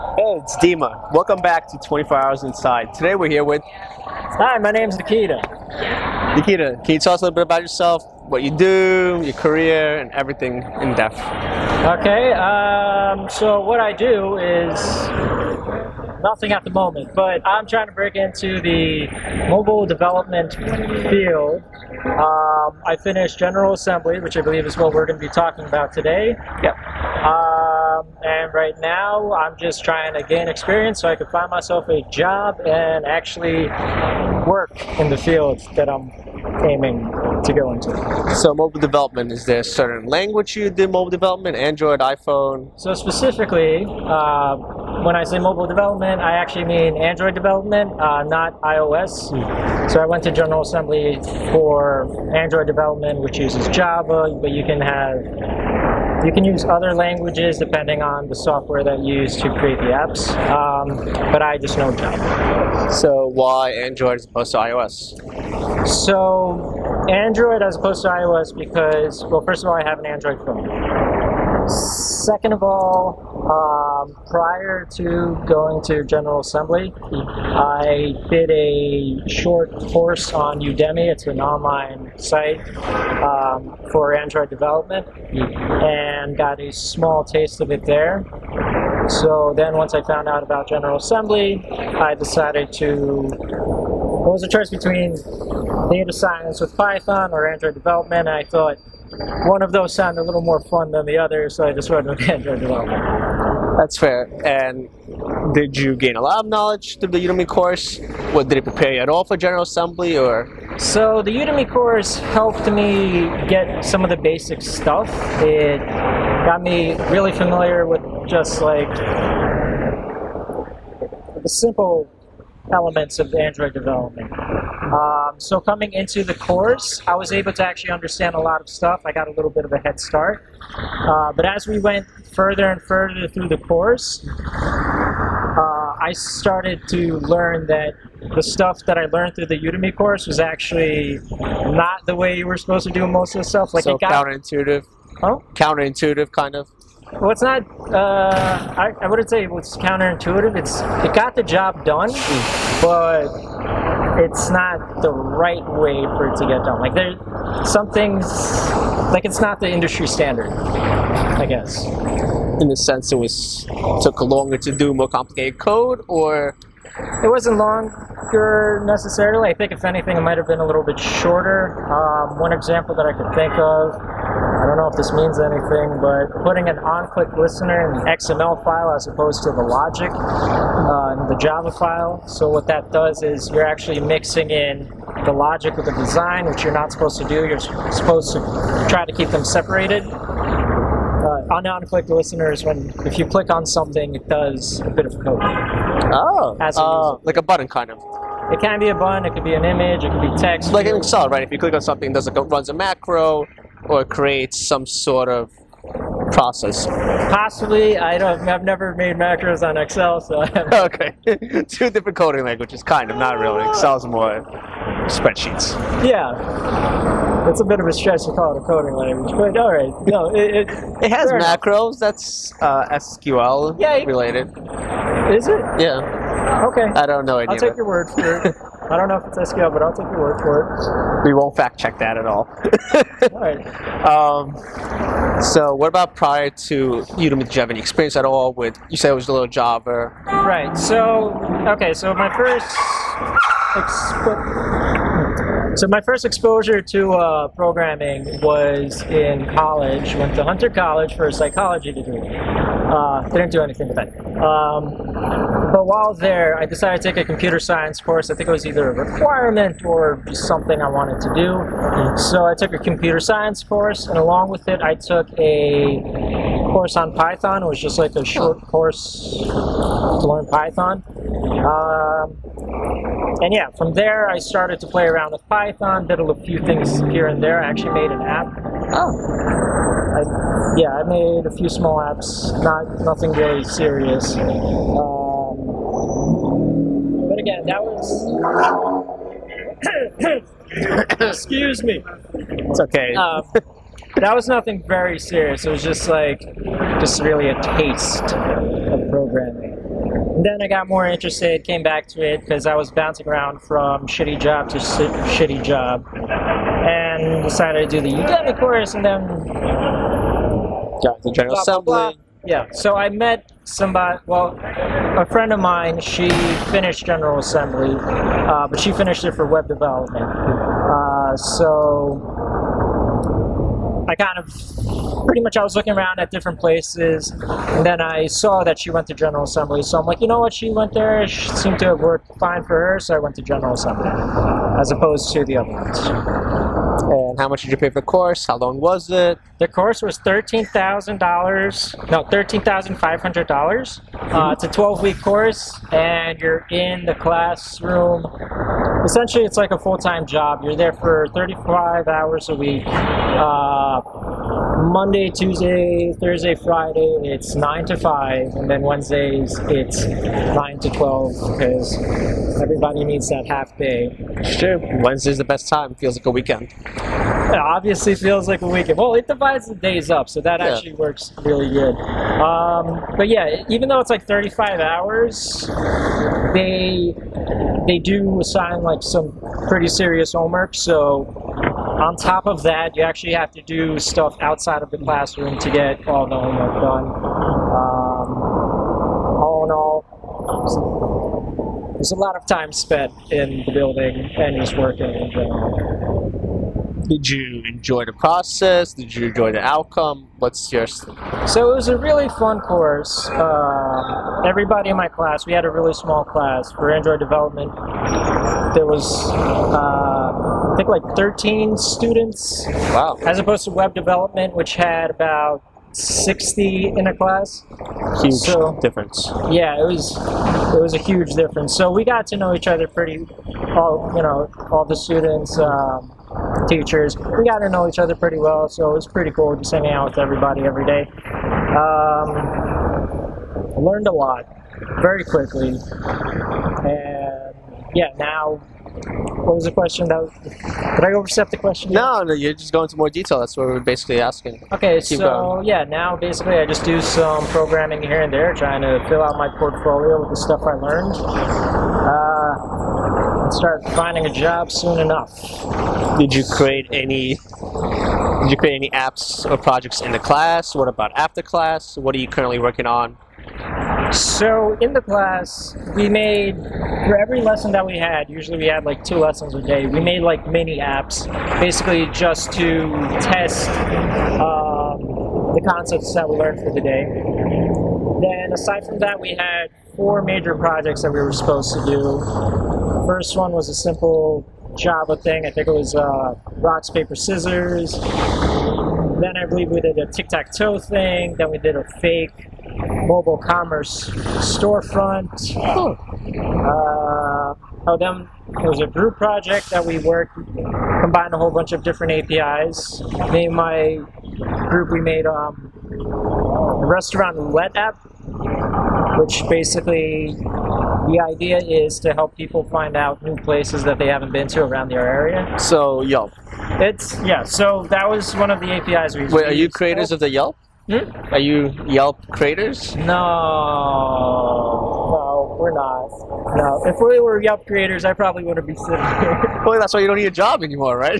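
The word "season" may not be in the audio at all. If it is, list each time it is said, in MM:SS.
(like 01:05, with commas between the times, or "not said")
not said.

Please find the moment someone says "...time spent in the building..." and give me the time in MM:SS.
06:32.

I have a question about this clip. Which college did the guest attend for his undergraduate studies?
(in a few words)
Hunter College.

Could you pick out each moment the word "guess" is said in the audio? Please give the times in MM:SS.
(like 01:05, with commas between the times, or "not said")
02:41.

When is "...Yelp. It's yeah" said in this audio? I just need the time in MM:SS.
08:36.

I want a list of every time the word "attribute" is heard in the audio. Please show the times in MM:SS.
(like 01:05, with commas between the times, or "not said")
not said.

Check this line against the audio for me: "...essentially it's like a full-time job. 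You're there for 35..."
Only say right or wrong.
right.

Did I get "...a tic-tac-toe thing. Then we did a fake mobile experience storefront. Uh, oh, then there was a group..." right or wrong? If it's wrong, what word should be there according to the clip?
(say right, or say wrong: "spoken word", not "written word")
wrong: "commerce", not "experience".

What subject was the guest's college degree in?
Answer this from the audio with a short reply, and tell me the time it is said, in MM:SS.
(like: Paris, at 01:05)
Psychology, at 04:11.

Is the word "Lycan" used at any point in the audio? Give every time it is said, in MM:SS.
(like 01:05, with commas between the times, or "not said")
not said.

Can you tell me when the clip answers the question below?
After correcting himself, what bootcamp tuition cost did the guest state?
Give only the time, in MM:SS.
05:42.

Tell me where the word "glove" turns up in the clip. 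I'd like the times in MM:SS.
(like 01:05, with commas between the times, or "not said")
not said.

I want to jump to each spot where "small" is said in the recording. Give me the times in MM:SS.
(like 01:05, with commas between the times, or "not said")
01:26, 04:41, 06:45.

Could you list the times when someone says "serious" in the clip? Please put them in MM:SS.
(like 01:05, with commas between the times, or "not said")
04:43, 04:55, 06:19.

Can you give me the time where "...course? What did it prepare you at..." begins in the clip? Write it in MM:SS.
01:47.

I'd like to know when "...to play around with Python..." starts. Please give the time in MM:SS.
04:34.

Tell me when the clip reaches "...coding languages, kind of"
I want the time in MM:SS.
03:32.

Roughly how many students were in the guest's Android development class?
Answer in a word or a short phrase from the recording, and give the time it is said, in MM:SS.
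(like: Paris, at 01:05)
13, at 06:51.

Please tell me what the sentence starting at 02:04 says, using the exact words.
Um, so coming into the course, I was able to actually understand a lot of stuff.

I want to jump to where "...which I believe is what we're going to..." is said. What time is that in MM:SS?
00:24.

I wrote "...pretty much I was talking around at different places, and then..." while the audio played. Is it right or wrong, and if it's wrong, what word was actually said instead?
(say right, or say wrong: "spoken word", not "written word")
wrong: "looking", not "talking".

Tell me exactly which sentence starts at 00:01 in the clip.
Welcome back to 24 Hours Inside.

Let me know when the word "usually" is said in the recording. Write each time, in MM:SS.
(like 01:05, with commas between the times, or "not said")
07:48.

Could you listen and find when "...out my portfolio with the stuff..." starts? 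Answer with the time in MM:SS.
07:29.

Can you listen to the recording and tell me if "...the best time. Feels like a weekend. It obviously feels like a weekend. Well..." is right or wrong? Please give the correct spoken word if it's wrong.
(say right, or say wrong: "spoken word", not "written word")
right.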